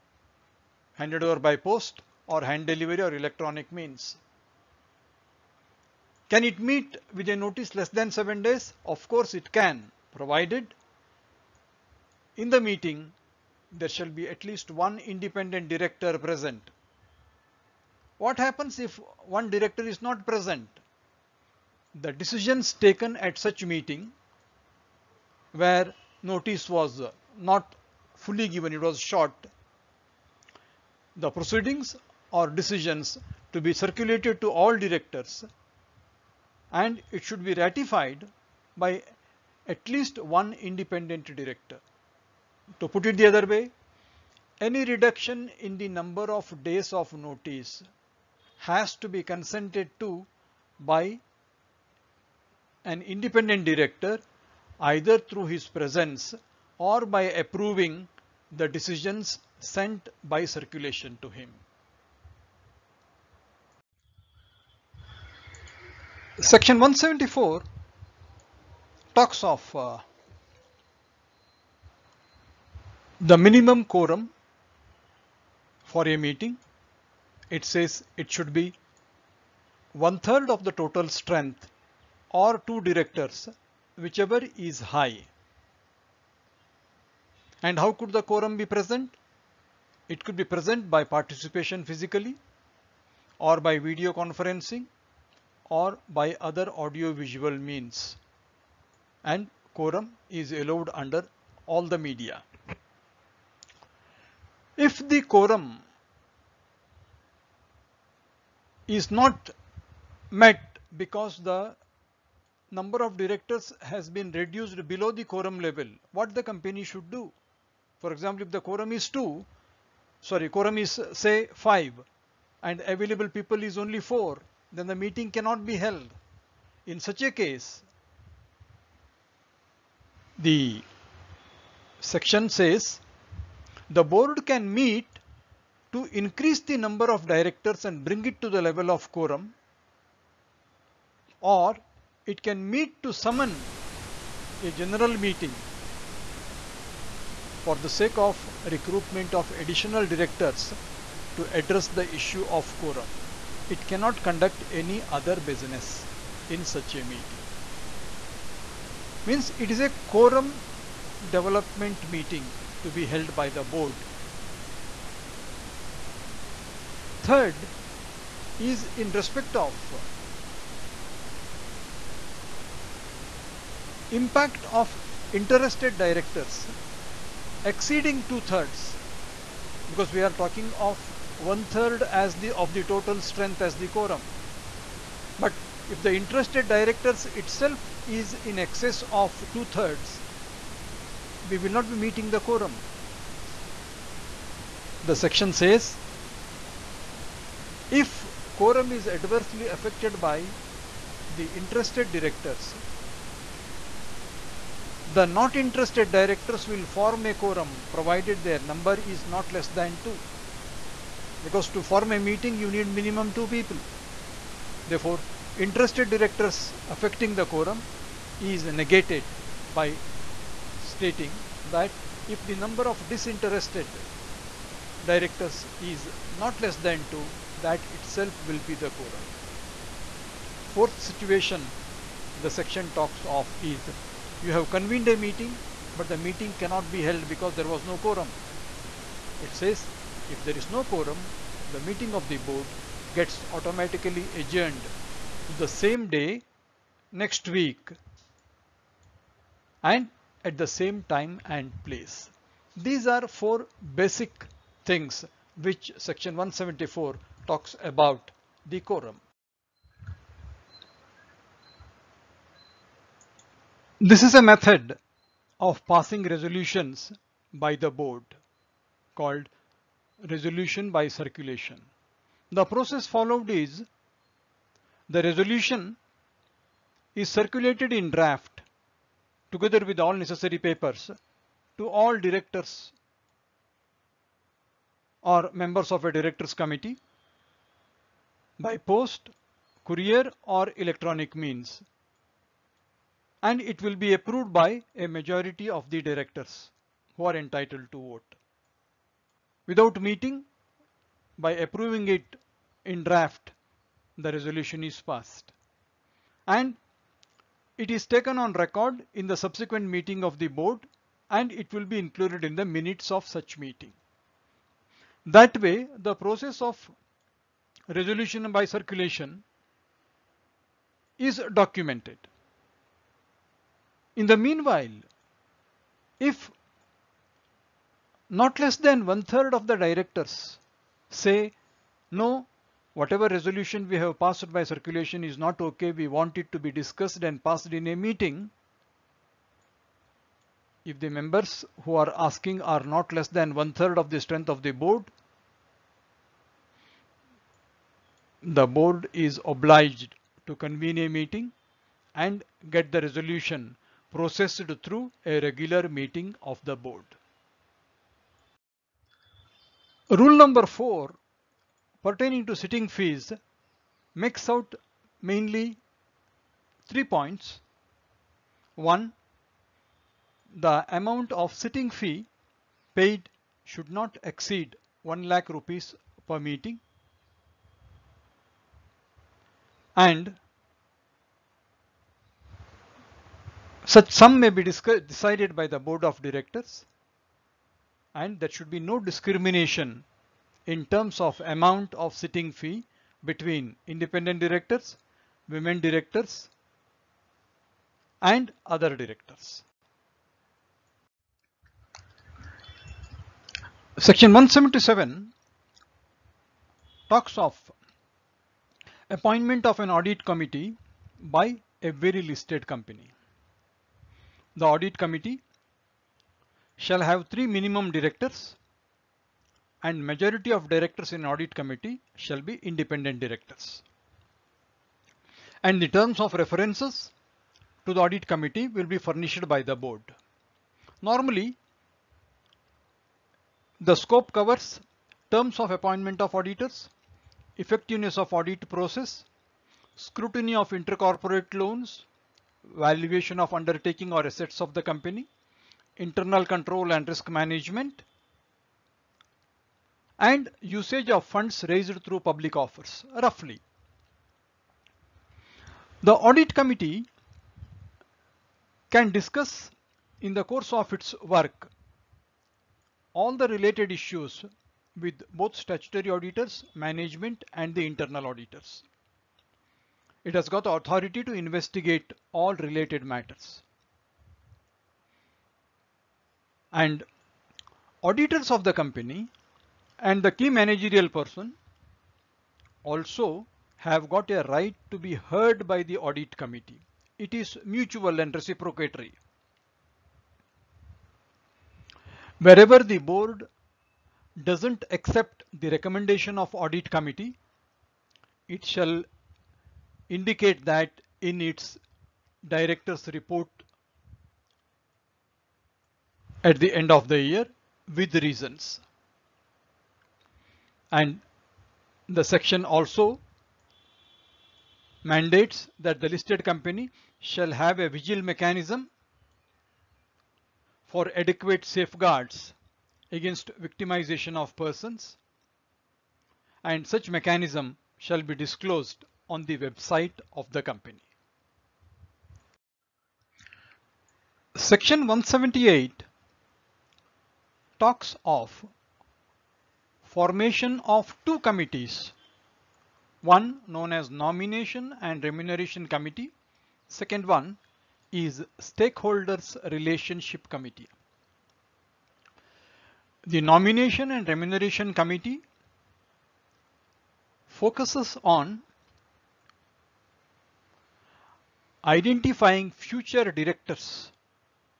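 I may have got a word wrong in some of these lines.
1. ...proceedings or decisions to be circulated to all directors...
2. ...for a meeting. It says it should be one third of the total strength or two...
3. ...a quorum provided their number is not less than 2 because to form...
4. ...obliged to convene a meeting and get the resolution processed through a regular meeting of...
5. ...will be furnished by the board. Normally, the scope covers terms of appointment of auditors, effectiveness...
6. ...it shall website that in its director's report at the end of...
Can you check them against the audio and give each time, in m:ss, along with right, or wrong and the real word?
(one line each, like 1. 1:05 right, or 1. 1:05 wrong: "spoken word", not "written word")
1. 0:31 right
2. 1:15 right
3. 3:27 right
4. 5:49 right
5. 7:08 right
6. 8:18 wrong: "indicate", not "website".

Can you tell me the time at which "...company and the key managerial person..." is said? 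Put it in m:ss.
7:58.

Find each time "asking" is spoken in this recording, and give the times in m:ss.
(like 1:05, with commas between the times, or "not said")
5:42.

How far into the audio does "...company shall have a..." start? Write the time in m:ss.
8:36.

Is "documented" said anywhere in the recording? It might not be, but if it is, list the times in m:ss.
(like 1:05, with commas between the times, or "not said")
5:21.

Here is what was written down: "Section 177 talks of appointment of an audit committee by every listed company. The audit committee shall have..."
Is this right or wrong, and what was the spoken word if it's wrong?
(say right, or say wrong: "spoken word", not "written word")
right.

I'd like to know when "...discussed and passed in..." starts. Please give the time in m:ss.
5:36.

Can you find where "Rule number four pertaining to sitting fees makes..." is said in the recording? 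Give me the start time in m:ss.
6:00.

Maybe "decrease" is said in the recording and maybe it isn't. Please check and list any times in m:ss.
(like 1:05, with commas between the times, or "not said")
not said.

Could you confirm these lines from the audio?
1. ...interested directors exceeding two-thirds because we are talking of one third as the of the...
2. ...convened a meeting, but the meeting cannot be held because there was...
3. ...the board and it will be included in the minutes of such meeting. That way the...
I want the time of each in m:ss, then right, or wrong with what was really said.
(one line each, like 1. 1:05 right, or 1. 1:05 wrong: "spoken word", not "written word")
1. 2:55 right
2. 3:54 right
3. 5:10 right.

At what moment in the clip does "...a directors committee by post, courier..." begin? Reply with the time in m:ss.
4:46.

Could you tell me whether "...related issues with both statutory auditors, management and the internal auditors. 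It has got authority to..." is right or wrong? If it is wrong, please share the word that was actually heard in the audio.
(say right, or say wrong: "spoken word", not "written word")
right.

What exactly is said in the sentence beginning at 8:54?
Section 178 talks of formation of two committees, one known as nomination and remuneration committee.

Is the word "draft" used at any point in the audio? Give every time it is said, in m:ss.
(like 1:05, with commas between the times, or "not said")
4:38, 5:03.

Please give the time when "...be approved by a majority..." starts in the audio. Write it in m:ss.
4:53.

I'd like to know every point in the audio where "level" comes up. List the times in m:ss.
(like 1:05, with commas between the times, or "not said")
1:55, 2:18.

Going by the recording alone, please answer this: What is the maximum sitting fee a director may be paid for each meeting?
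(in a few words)
1 lakh rupees.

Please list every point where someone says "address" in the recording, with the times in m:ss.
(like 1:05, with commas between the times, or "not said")
2:31.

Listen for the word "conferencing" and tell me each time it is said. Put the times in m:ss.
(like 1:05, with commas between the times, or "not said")
1:34.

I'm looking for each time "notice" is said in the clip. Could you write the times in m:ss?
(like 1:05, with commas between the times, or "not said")
0:07, 0:26, 0:47.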